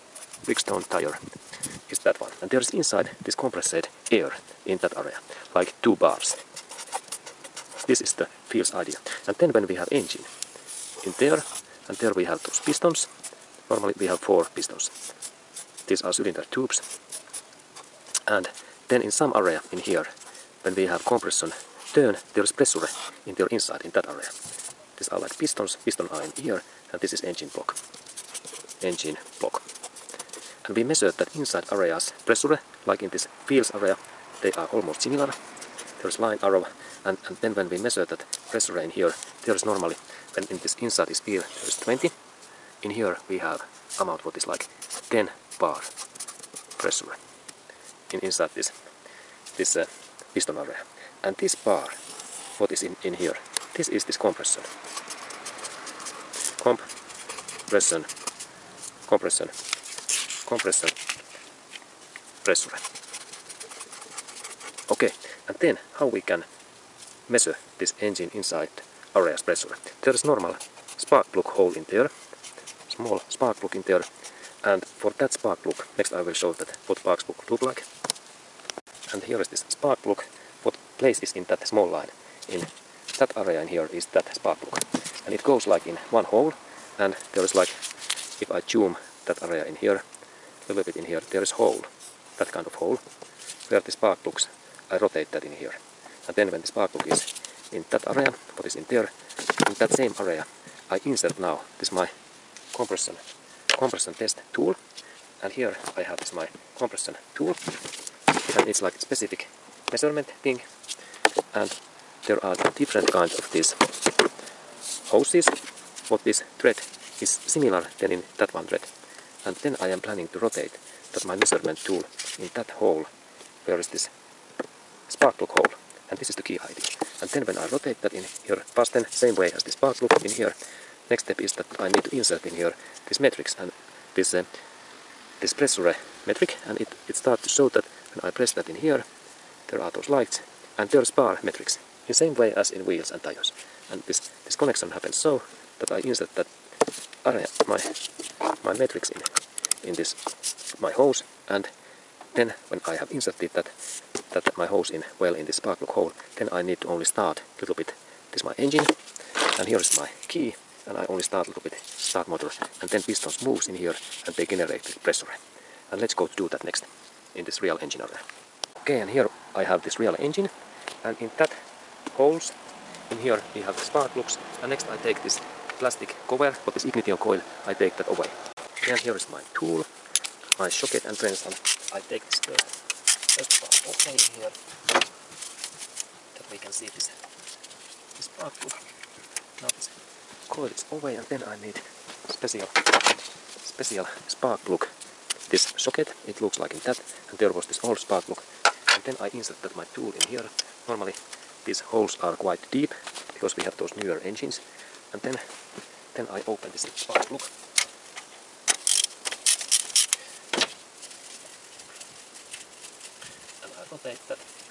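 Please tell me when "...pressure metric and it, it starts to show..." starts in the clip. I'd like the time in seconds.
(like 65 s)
135 s.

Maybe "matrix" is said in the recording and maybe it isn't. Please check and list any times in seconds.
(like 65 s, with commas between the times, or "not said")
133 s, 148 s.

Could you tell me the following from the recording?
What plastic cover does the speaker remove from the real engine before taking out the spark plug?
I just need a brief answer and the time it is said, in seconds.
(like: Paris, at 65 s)
ignition coil, at 176 s.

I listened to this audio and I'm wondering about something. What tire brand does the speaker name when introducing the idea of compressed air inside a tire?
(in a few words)
Bridgestone.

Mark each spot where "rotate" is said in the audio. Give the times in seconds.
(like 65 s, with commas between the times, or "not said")
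94 s, 120 s, 127 s, 213 s.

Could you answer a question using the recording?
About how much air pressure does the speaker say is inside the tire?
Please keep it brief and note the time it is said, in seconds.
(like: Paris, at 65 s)
2 bars, at 5 s.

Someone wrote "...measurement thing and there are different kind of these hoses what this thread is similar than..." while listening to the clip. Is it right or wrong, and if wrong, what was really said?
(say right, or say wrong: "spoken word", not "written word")
right.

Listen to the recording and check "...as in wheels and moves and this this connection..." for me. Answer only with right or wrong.
wrong.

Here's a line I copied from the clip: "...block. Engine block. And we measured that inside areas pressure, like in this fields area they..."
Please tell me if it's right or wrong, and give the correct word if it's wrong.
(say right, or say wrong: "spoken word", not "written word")
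right.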